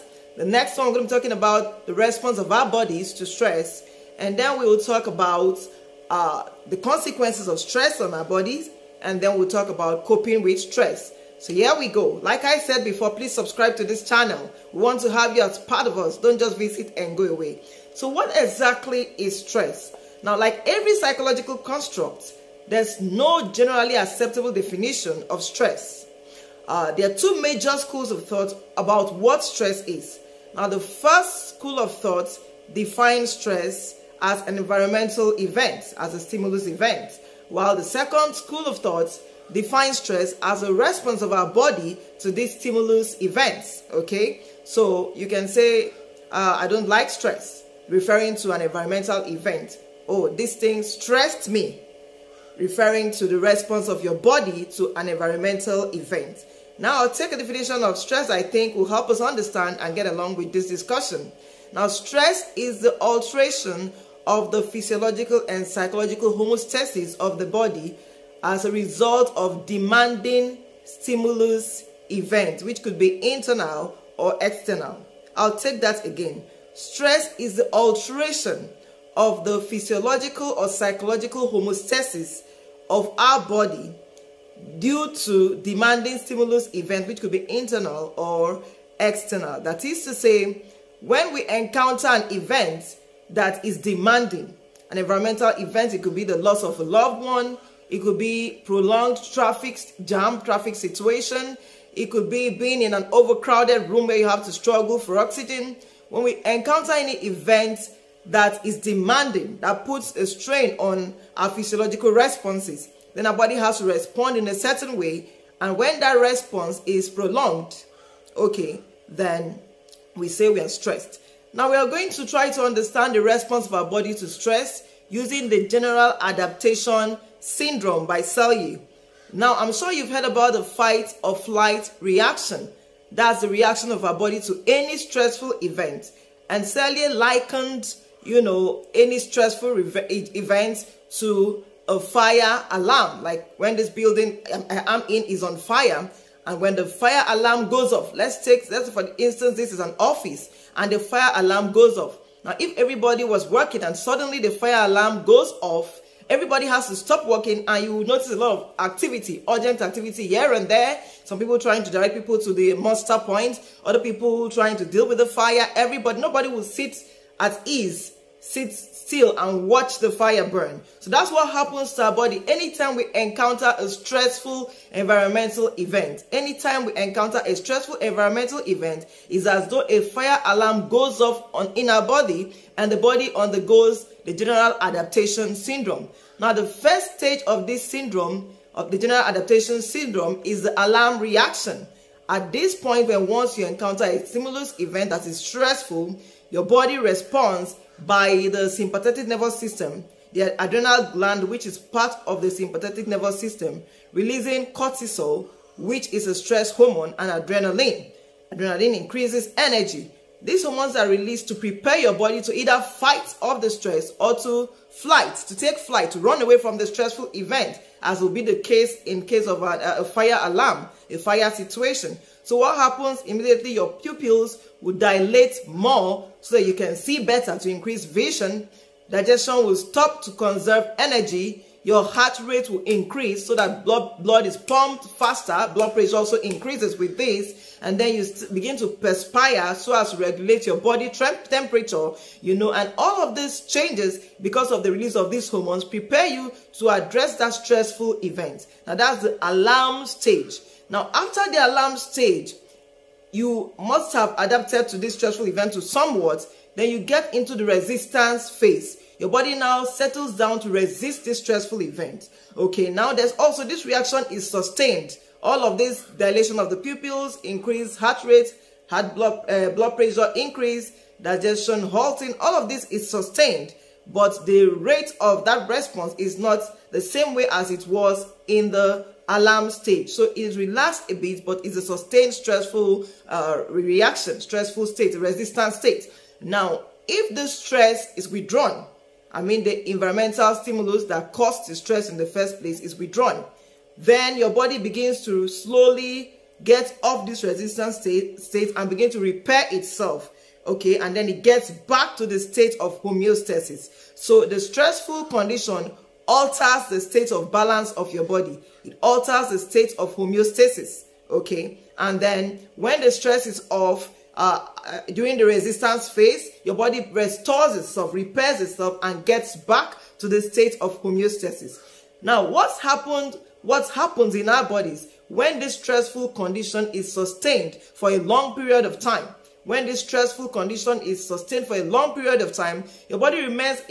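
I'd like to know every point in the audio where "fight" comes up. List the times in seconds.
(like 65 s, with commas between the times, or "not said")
130 s, 212 s.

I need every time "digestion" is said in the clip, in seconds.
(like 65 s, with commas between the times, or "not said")
229 s, 271 s.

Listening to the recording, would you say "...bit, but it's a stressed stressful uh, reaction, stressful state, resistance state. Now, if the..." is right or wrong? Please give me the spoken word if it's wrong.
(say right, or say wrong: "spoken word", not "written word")
wrong: "sustained", not "stressed".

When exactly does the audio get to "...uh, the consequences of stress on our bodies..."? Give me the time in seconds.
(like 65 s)
6 s.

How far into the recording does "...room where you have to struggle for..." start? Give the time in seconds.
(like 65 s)
103 s.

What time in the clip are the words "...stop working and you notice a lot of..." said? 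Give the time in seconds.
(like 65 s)
156 s.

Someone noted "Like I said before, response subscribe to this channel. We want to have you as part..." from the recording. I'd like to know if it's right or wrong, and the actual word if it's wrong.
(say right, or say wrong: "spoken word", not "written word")
wrong: "please", not "response".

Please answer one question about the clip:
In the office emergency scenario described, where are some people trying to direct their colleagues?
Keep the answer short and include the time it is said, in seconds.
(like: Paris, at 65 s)
muster point, at 162 s.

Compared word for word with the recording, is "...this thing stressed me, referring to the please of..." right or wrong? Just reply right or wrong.
wrong.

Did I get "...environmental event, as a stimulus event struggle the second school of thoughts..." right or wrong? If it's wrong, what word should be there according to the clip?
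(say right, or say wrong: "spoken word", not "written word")
wrong: "while", not "struggle".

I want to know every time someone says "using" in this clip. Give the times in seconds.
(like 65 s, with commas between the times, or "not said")
125 s.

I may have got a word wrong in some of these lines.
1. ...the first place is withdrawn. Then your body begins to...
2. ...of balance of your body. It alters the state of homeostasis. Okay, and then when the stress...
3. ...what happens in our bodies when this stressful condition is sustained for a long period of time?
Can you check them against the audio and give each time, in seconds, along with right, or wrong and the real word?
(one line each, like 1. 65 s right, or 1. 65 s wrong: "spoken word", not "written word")
1. 292 s right
2. 307 s right
3. 323 s right.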